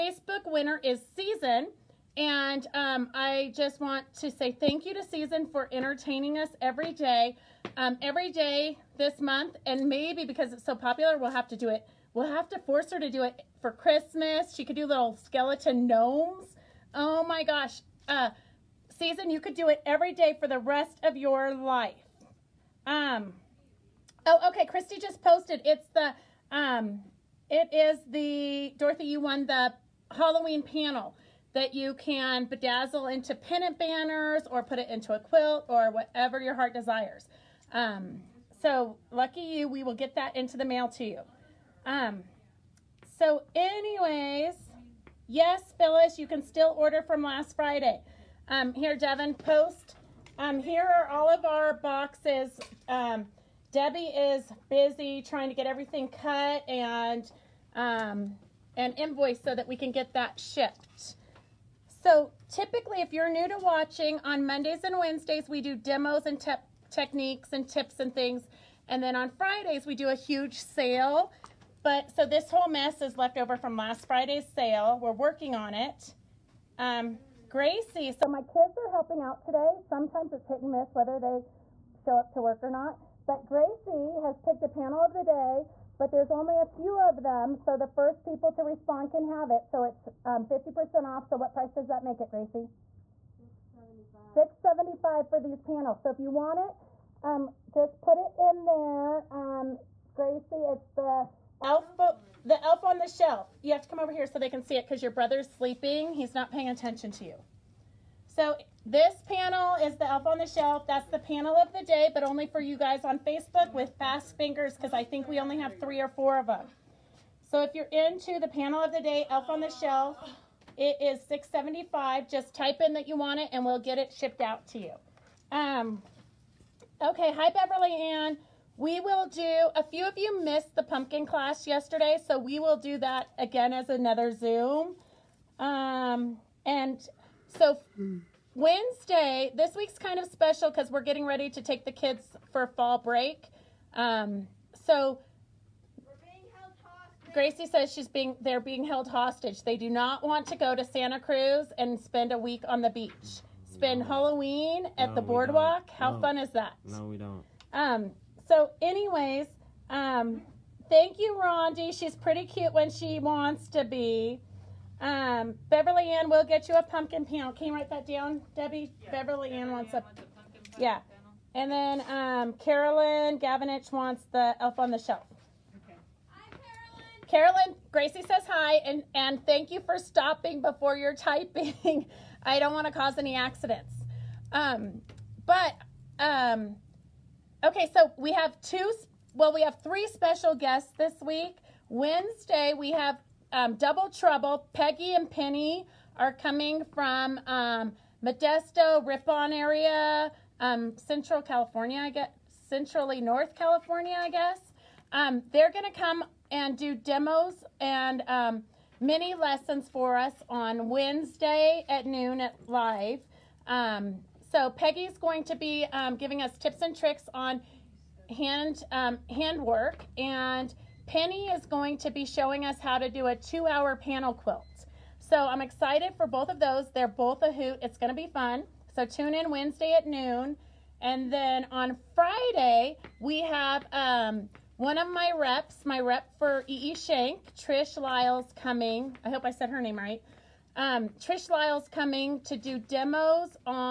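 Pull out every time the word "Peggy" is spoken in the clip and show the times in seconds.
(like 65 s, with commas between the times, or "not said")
194 s, 214 s.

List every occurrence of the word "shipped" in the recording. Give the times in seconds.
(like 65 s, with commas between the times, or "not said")
60 s, 124 s.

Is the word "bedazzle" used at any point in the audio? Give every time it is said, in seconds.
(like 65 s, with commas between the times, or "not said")
32 s.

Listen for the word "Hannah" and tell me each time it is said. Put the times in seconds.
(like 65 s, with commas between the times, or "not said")
not said.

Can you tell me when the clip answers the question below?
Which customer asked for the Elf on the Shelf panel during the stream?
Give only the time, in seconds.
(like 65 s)
172 s.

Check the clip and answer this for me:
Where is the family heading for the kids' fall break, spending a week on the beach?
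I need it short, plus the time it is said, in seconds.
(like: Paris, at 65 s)
Santa Cruz, at 150 s.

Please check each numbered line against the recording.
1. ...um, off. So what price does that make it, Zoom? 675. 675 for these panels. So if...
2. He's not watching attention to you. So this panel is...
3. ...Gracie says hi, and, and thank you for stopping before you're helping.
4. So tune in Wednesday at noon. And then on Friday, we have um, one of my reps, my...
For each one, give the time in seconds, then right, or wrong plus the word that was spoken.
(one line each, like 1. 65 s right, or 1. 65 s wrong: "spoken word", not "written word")
1. 90 s wrong: "Gracie", not "Zoom"
2. 106 s wrong: "paying", not "watching"
3. 177 s wrong: "typing", not "helping"
4. 228 s right.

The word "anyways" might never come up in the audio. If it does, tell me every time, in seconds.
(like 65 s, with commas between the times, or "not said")
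43 s, 158 s.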